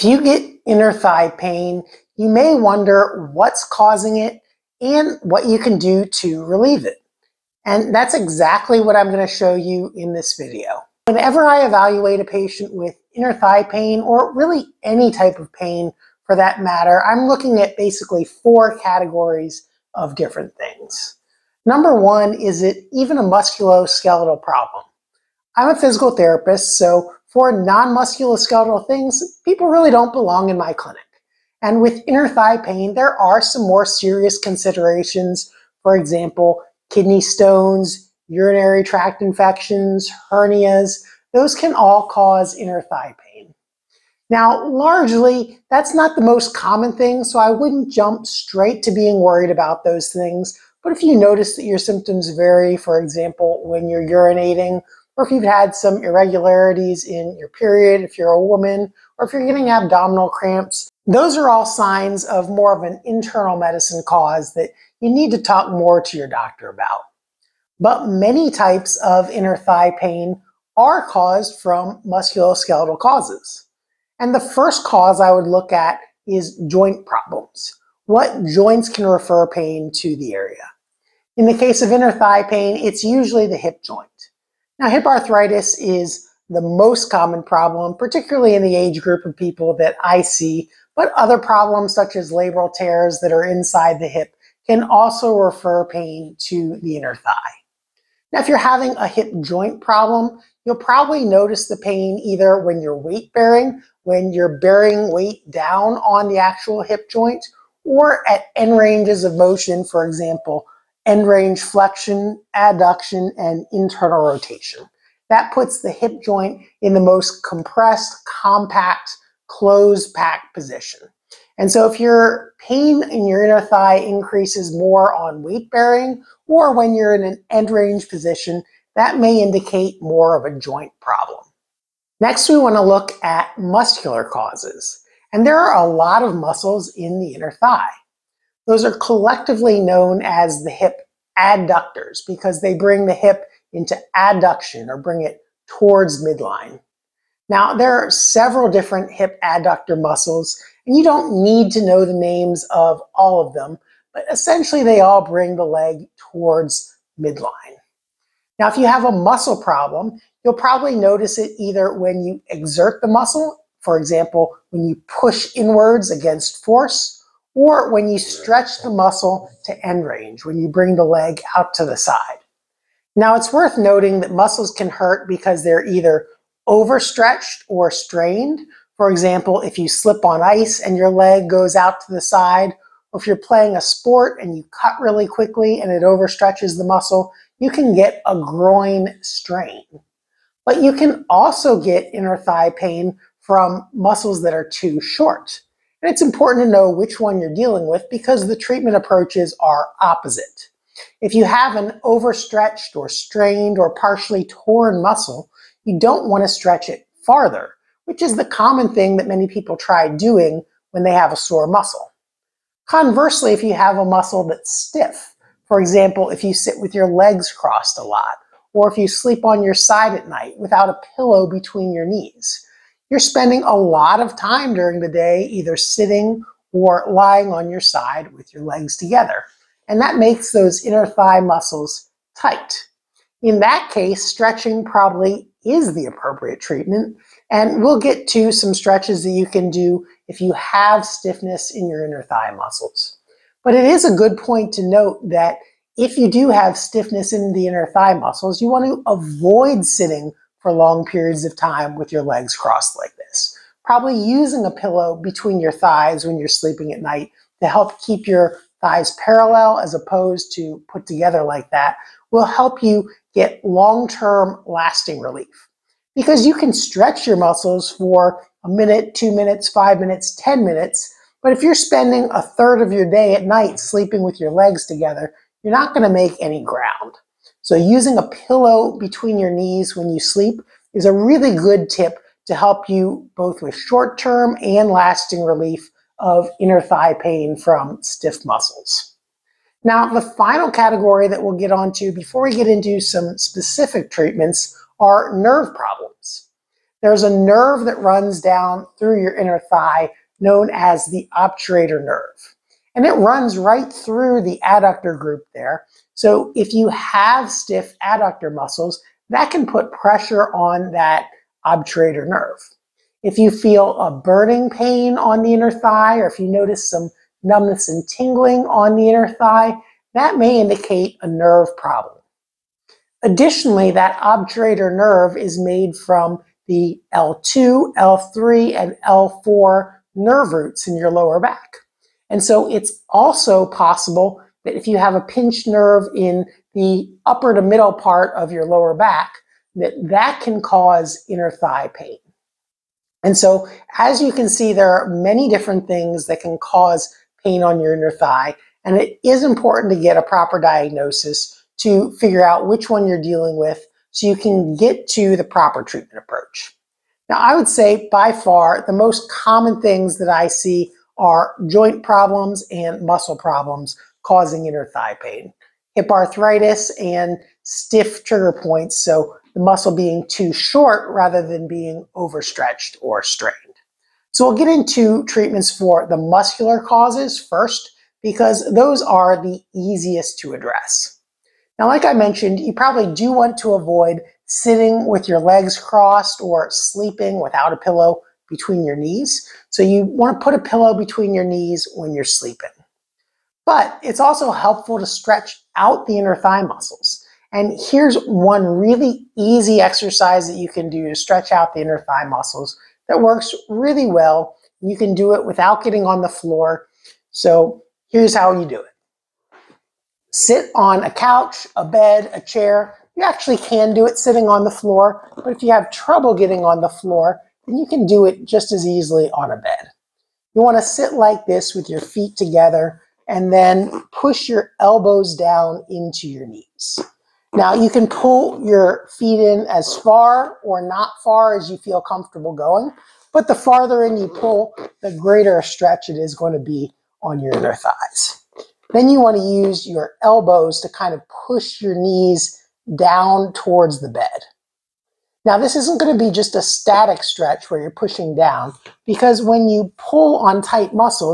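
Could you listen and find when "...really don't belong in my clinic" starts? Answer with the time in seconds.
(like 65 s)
29 s.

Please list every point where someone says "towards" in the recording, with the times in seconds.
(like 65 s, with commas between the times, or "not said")
145 s, 156 s, 443 s.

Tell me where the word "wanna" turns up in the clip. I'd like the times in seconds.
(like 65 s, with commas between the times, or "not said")
420 s.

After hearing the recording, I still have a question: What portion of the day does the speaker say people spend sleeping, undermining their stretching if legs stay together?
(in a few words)
A third.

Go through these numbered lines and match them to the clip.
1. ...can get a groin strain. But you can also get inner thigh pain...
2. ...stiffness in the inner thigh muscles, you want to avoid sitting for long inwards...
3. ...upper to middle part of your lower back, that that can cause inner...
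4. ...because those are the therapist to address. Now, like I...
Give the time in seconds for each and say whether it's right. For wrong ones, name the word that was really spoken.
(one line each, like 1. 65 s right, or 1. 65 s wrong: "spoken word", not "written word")
1. 187 s right
2. 246 s wrong: "periods", not "inwards"
3. 337 s right
4. 378 s wrong: "easiest", not "therapist".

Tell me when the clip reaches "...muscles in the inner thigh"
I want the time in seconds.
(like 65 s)
136 s.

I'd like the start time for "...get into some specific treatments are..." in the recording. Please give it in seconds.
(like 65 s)
292 s.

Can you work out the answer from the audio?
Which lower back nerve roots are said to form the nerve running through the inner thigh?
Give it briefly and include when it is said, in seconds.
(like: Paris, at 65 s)
L2, L3, and L4, at 327 s.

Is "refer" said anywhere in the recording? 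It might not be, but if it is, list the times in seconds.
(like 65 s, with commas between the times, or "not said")
79 s, 95 s.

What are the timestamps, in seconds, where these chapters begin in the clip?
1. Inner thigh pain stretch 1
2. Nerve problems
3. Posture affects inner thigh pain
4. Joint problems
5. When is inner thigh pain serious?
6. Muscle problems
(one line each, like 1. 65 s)
1. 416 s
2. 309 s
3. 393 s
4. 93 s
5. 50 s
6. 151 s.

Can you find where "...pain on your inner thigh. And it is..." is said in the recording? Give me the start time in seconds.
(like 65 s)
347 s.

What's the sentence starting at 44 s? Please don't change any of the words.
Now, largely, that's not the most common thing, so I wouldn't jump straight to being worried about those things.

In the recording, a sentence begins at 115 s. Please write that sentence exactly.
That puts the hip joint in the most compressed, compact, closed pack position.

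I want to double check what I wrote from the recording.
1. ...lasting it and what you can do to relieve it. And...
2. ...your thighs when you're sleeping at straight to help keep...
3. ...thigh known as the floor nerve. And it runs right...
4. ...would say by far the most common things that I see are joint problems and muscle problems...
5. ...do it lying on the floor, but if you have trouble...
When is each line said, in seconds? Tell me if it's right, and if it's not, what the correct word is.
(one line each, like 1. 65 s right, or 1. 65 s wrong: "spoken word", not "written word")
1. 3 s wrong: "causing", not "lasting"
2. 255 s wrong: "night", not "straight"
3. 299 s wrong: "obturator", not "floor"
4. 357 s right
5. 413 s wrong: "sitting", not "lying".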